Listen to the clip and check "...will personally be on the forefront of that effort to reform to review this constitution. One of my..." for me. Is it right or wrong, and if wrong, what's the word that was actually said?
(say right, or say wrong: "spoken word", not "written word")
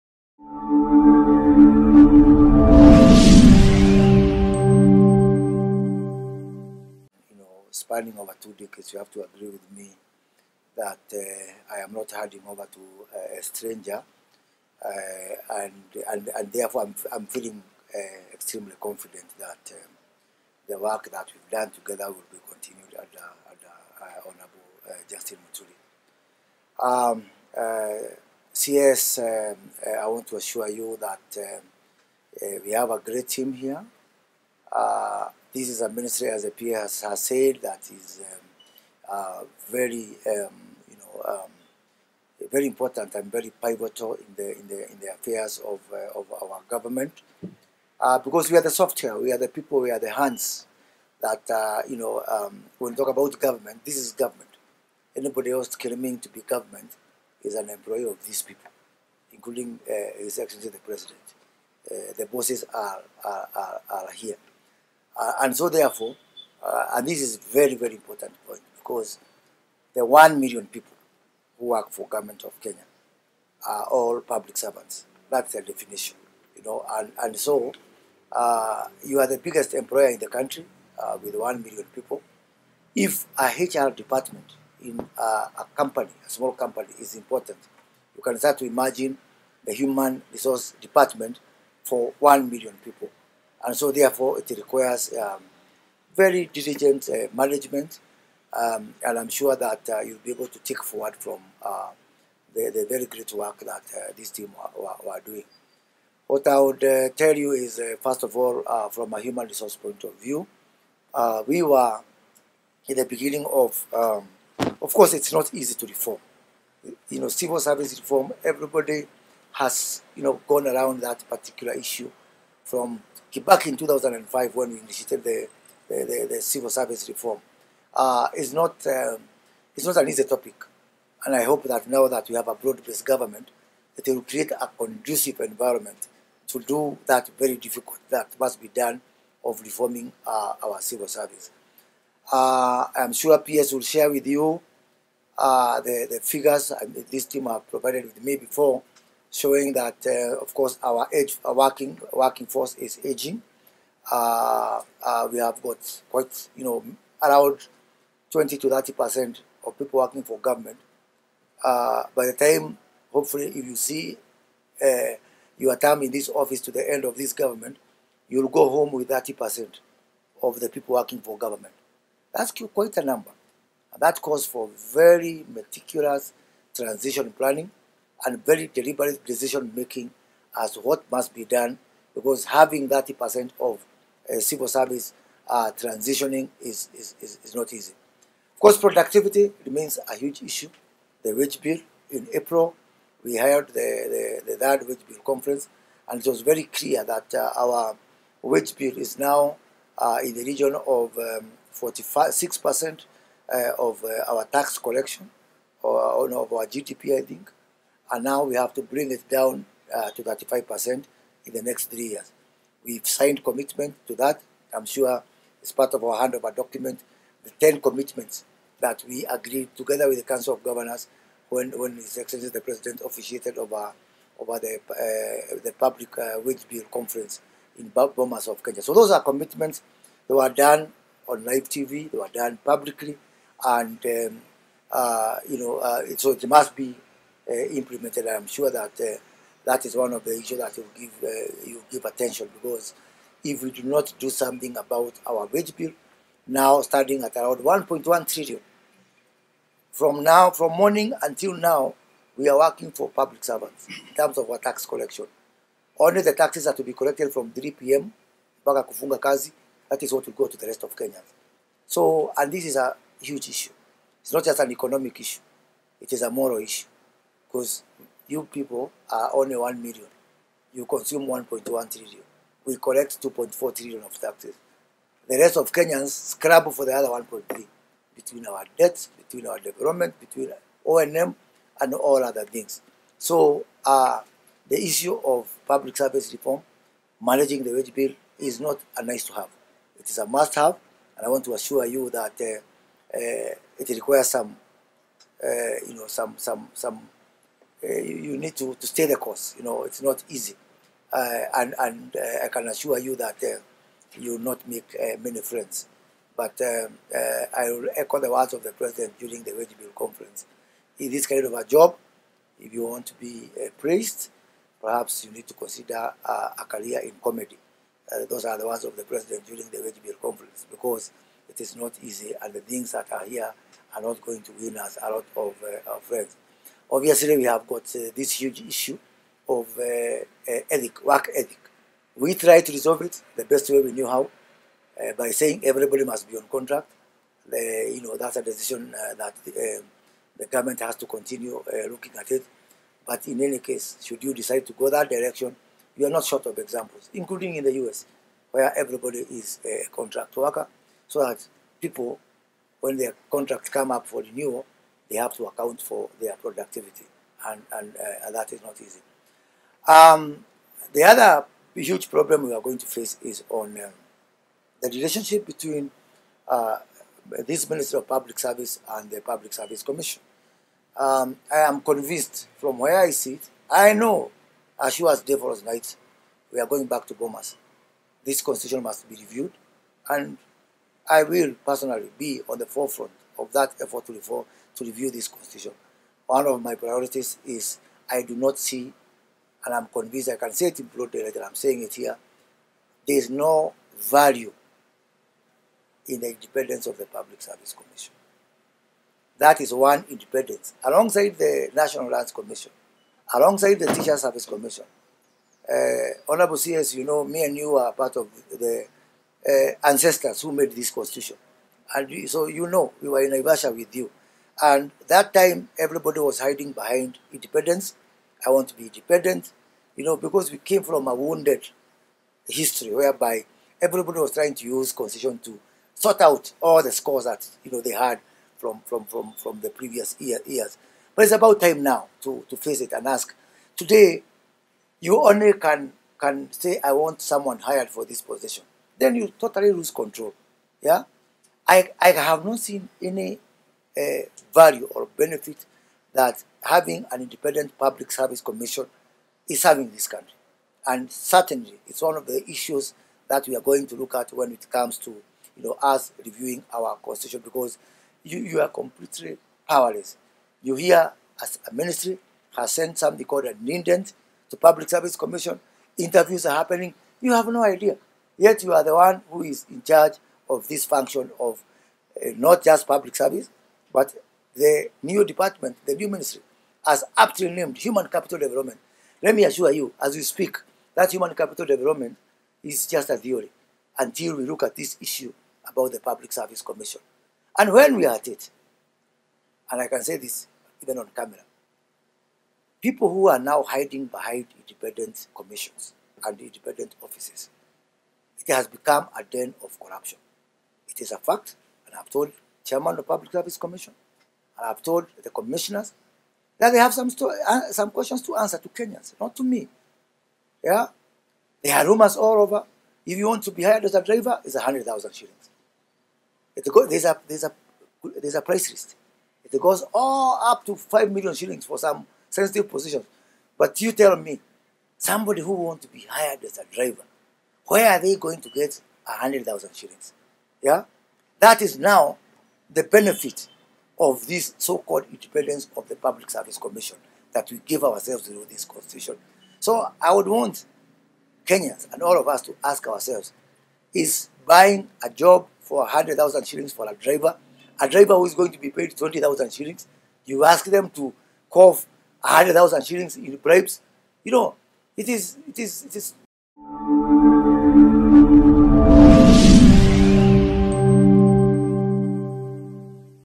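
right.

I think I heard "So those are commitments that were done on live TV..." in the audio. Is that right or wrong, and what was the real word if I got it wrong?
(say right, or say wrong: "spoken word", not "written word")
right.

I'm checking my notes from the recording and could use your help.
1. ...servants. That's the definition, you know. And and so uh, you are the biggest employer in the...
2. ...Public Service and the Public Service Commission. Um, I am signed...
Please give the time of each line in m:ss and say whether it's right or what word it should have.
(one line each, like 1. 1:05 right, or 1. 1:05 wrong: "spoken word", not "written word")
1. 1:14 right
2. 6:08 wrong: "convinced", not "signed".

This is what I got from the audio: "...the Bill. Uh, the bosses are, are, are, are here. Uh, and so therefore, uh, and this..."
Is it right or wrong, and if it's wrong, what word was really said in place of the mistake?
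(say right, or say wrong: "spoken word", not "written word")
wrong: "President", not "Bill".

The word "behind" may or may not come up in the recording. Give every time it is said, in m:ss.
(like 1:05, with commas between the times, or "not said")
6:56, 8:14.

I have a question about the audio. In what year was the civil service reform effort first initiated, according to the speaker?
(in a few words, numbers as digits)
2005.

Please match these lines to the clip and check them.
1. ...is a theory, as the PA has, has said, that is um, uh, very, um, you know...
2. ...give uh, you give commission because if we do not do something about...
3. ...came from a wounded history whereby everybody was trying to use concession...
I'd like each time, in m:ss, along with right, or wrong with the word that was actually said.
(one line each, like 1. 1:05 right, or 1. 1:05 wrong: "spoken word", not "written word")
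1. 0:35 wrong: "ministry", not "theory"
2. 4:00 wrong: "attention", not "commission"
3. 7:00 right.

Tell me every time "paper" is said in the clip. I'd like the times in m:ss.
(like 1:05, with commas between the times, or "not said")
not said.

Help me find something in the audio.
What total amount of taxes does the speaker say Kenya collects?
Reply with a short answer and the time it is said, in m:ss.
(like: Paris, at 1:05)
2.4 trillion, at 4:33.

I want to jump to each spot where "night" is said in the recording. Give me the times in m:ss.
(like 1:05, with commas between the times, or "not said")
6:15.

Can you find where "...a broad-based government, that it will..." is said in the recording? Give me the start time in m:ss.
2:12.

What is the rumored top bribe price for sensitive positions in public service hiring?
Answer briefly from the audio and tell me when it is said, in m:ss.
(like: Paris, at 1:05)
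5 million shillings, at 8:40.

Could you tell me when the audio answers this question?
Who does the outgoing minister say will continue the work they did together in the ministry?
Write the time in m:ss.
0:25.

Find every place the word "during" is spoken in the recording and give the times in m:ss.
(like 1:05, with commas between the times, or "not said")
5:09, 5:19.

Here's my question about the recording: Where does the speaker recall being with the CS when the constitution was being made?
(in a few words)
Naivasha.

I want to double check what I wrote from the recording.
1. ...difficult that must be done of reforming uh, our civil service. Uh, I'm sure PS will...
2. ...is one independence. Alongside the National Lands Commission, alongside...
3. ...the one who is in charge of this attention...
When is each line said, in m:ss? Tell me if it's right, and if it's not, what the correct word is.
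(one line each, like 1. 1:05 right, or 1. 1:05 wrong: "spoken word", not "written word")
1. 2:17 right
2. 6:39 right
3. 7:48 wrong: "function", not "attention".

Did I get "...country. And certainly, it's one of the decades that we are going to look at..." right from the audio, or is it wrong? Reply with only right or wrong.
wrong.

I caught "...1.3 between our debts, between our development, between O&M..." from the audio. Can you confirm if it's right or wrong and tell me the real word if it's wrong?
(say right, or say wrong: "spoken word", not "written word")
right.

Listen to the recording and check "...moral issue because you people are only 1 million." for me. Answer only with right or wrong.
right.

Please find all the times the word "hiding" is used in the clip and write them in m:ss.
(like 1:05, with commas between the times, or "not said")
6:56, 8:13.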